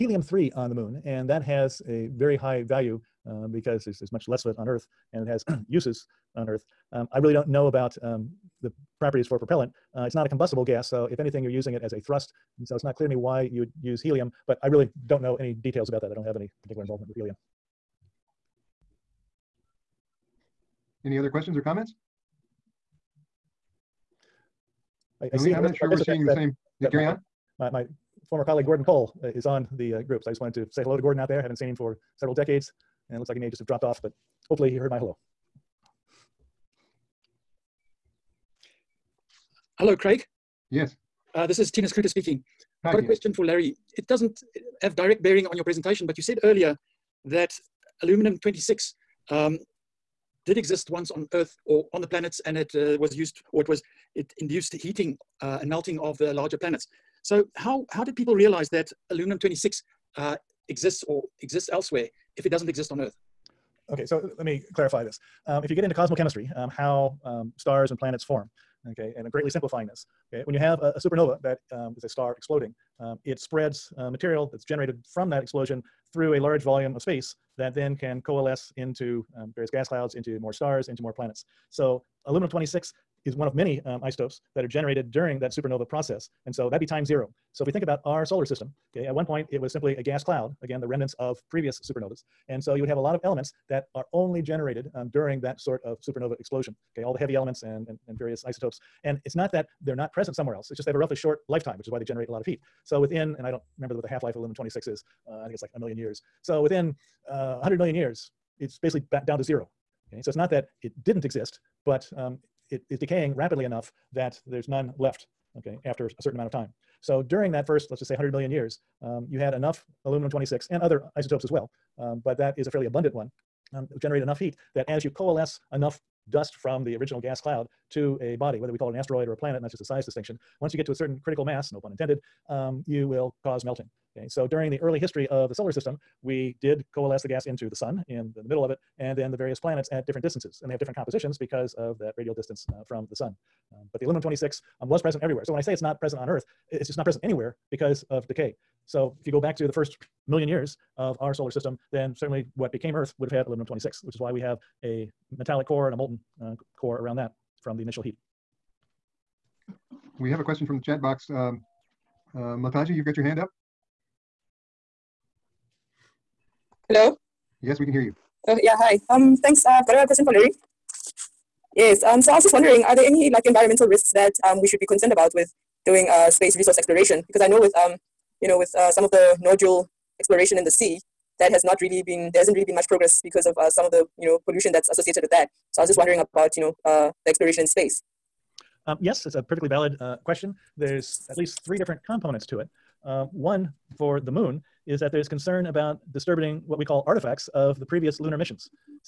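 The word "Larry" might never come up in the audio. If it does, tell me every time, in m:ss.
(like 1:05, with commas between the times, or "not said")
0:43, 2:50.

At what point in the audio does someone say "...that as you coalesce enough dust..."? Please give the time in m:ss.
2:04.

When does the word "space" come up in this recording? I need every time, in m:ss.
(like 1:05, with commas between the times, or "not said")
1:17, 2:56, 3:07.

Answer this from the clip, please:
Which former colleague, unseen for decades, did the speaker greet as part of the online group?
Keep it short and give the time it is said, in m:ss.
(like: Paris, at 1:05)
Gordon Cole, at 0:28.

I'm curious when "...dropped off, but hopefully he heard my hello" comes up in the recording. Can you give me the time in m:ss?
0:33.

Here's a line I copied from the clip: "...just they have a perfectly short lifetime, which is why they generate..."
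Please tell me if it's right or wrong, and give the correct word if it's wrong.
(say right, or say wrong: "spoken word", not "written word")
wrong: "relatively", not "perfectly".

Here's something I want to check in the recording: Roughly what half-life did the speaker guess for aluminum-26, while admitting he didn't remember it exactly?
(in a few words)
1 million years.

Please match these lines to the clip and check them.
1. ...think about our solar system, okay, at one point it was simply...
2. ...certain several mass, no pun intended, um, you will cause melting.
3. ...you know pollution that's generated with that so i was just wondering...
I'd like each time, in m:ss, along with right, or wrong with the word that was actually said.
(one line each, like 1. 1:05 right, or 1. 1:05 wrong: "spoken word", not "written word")
1. 1:27 right
2. 2:10 wrong: "critical", not "several"
3. 3:04 wrong: "associated", not "generated".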